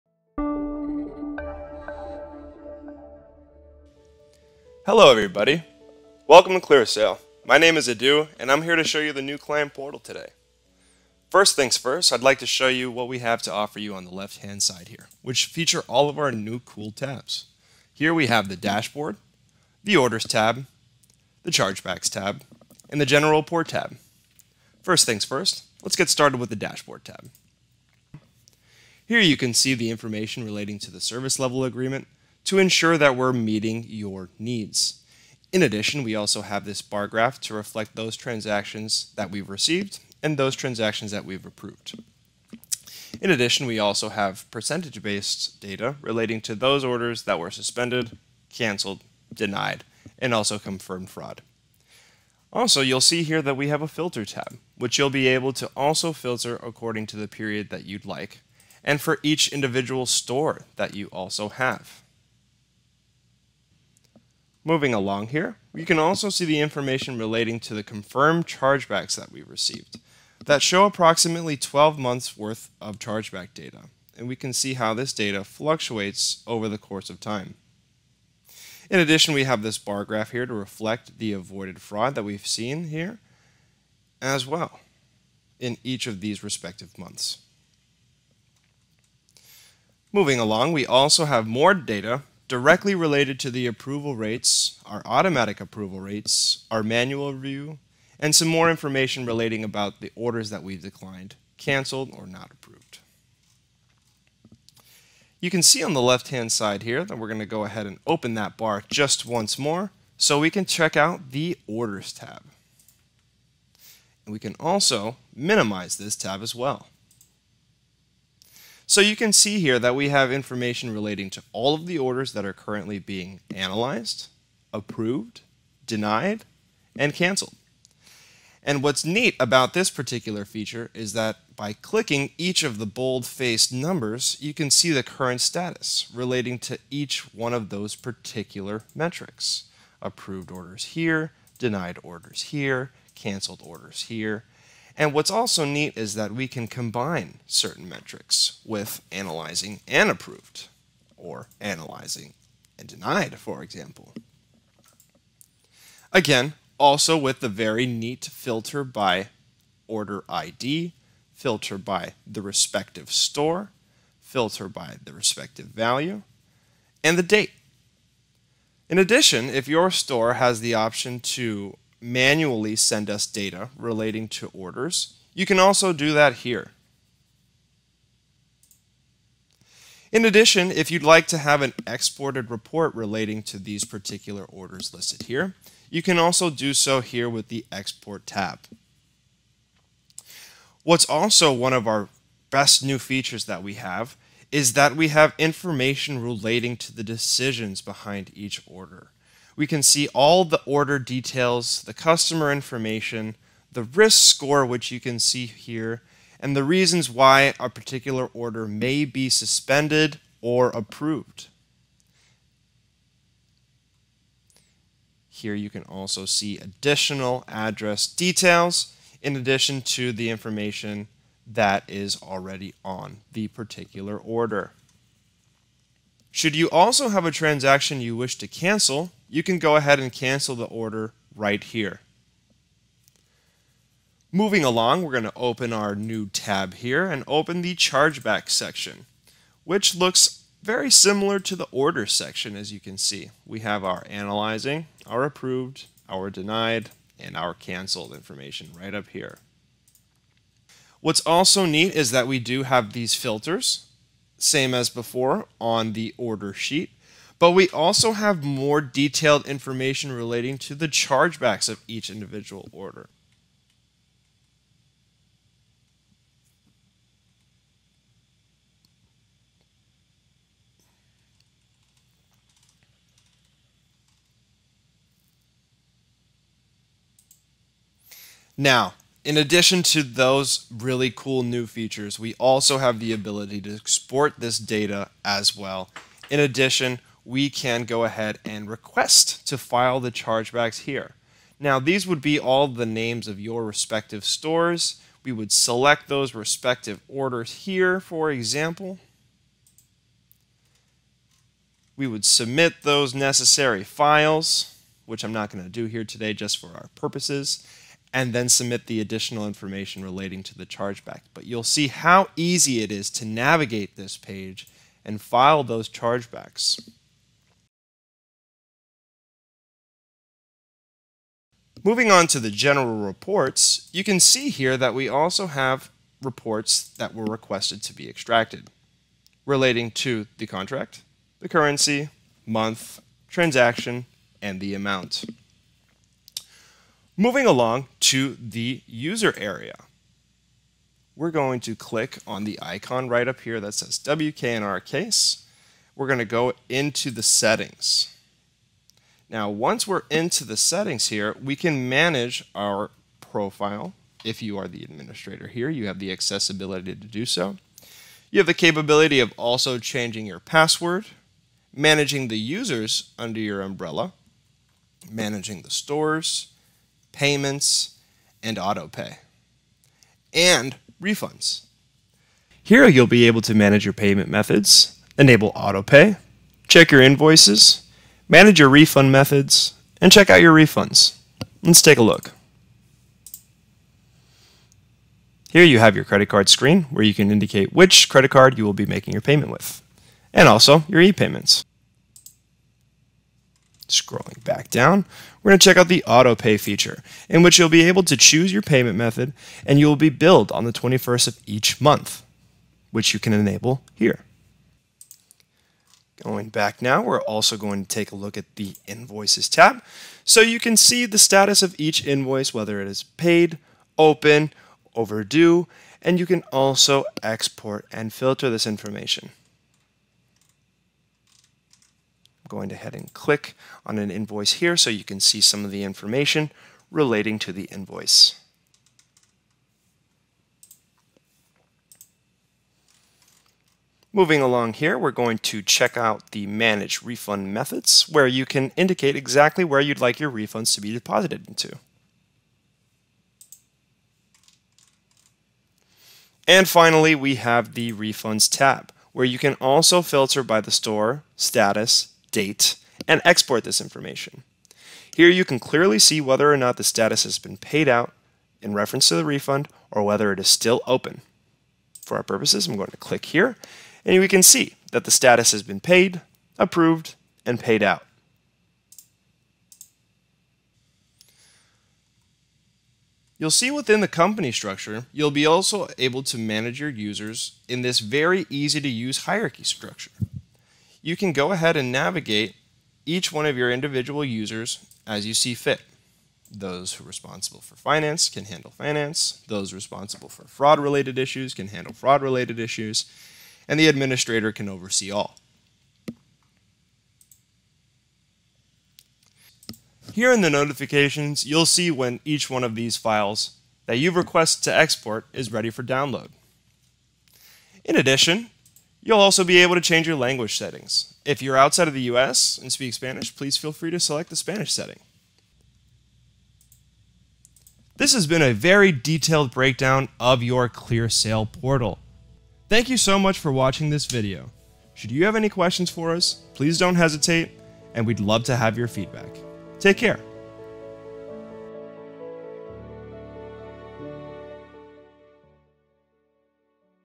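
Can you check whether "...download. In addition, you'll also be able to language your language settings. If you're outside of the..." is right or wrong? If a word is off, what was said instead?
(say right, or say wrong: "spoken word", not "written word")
wrong: "change", not "language".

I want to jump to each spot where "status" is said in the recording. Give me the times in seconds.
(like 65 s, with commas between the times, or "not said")
135 s, 411 s, 451 s, 456 s, 465 s.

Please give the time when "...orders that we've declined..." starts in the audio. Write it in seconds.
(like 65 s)
100 s.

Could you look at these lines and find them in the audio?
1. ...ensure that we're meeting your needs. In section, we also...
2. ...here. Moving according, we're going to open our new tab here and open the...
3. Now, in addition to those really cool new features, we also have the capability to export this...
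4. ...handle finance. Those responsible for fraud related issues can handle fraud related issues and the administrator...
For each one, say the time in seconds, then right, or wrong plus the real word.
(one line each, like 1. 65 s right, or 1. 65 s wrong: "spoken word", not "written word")
1. 32 s wrong: "addition", not "section"
2. 231 s wrong: "along", not "according"
3. 278 s wrong: "ability", not "capability"
4. 488 s right.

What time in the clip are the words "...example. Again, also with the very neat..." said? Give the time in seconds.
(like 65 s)
153 s.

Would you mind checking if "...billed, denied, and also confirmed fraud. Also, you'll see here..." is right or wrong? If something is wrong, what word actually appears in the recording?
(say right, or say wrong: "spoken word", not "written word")
wrong: "canceled", not "billed".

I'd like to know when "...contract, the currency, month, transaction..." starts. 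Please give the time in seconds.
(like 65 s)
330 s.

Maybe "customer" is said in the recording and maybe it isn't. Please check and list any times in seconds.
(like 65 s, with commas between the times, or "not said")
201 s.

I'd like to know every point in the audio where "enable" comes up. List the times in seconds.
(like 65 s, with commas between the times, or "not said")
375 s, 403 s.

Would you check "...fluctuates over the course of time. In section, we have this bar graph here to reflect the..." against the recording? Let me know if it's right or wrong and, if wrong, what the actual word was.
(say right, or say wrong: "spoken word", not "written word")
wrong: "addition", not "section".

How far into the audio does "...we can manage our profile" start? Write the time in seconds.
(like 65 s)
351 s.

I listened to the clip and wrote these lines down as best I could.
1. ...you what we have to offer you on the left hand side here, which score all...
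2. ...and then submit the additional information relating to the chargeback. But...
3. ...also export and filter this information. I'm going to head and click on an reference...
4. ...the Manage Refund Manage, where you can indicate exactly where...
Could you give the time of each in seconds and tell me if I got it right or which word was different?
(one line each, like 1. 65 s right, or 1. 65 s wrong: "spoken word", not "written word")
1. 12 s wrong: "feature", not "score"
2. 308 s right
3. 416 s wrong: "invoice", not "reference"
4. 436 s wrong: "Methods", not "Manage".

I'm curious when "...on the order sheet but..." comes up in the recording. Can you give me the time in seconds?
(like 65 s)
255 s.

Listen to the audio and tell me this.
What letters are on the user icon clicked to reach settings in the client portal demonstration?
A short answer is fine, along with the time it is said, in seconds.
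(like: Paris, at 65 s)
WK, at 343 s.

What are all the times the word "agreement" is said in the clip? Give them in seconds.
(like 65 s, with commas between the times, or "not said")
31 s.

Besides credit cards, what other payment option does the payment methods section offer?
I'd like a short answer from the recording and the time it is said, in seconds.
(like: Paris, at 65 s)
e-payments, at 391 s.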